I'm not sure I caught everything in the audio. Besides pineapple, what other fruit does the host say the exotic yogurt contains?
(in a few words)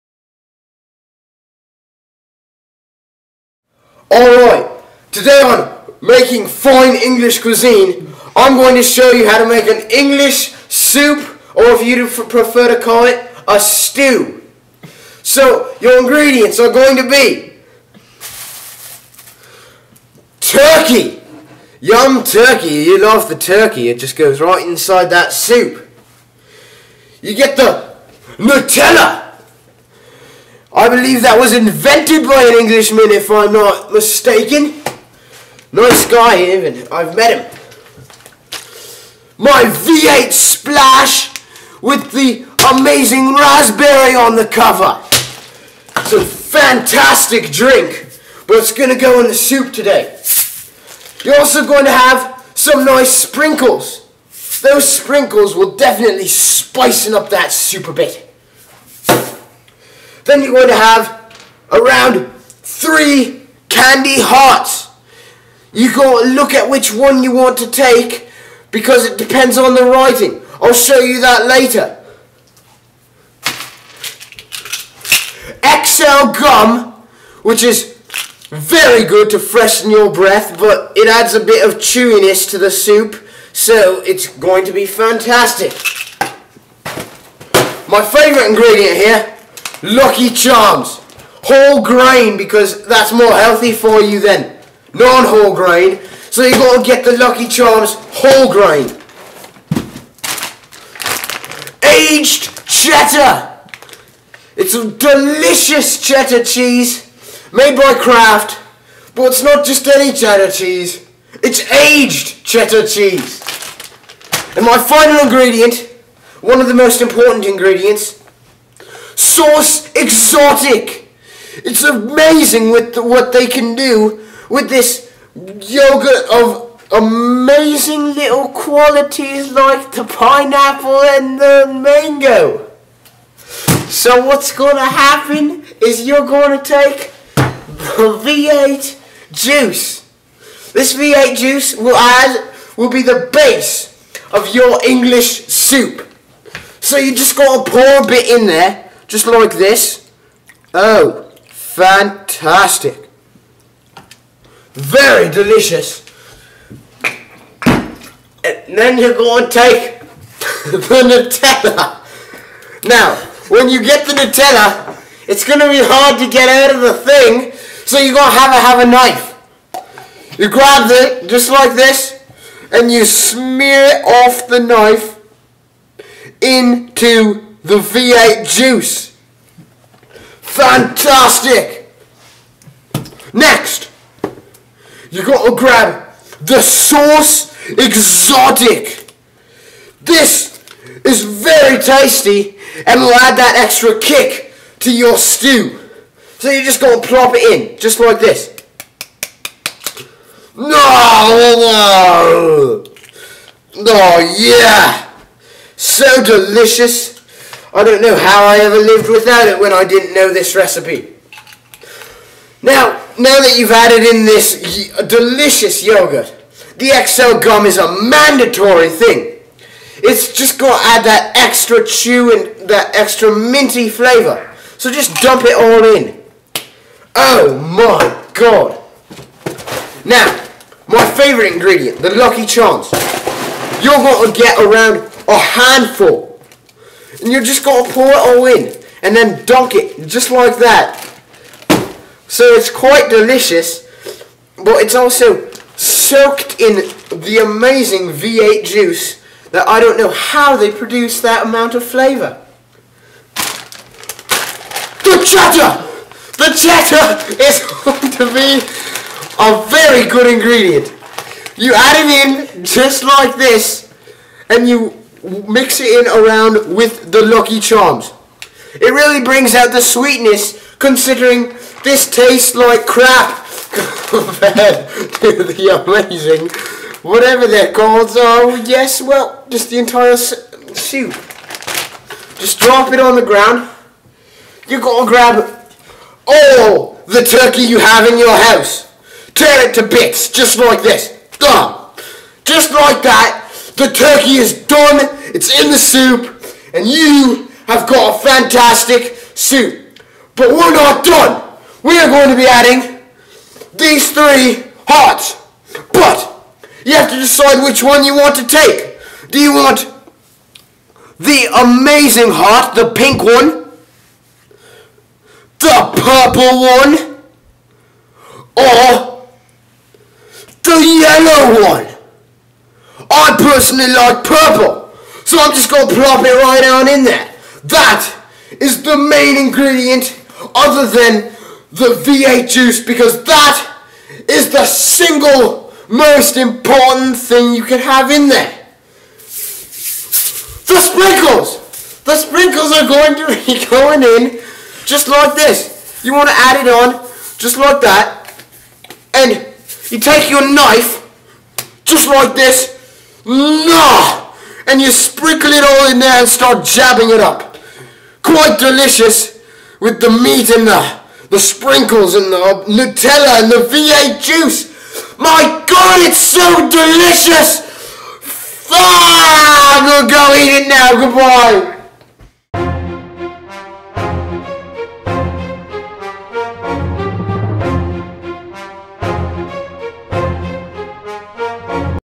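Mango.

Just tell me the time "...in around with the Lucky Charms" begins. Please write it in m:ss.
4:25.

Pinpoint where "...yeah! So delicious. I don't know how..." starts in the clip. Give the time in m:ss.
3:24.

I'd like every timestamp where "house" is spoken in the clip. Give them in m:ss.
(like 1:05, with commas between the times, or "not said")
4:48.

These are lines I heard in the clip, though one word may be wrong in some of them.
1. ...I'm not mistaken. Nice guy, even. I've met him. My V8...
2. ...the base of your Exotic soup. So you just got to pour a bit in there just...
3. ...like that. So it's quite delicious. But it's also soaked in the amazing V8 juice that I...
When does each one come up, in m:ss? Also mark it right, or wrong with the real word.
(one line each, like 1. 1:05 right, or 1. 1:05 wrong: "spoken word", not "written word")
1. 0:33 right
2. 2:23 wrong: "English", not "Exotic"
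3. 4:00 right.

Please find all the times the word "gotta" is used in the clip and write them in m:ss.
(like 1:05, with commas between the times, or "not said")
3:05, 3:16, 4:44.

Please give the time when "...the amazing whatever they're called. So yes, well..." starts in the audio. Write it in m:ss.
4:35.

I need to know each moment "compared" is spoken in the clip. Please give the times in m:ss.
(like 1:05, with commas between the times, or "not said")
4:34.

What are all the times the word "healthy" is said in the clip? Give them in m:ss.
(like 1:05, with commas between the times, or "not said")
1:33.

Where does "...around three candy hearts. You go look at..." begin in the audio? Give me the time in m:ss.
1:01.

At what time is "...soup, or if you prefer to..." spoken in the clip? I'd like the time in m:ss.
0:10.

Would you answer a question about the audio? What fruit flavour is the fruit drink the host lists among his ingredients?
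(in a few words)
Raspberry.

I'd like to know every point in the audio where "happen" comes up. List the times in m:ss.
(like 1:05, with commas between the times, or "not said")
2:14.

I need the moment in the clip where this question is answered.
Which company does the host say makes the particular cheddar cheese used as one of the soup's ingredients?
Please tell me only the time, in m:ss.
1:47.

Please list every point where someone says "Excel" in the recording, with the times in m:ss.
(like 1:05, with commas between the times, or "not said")
1:15, 3:36.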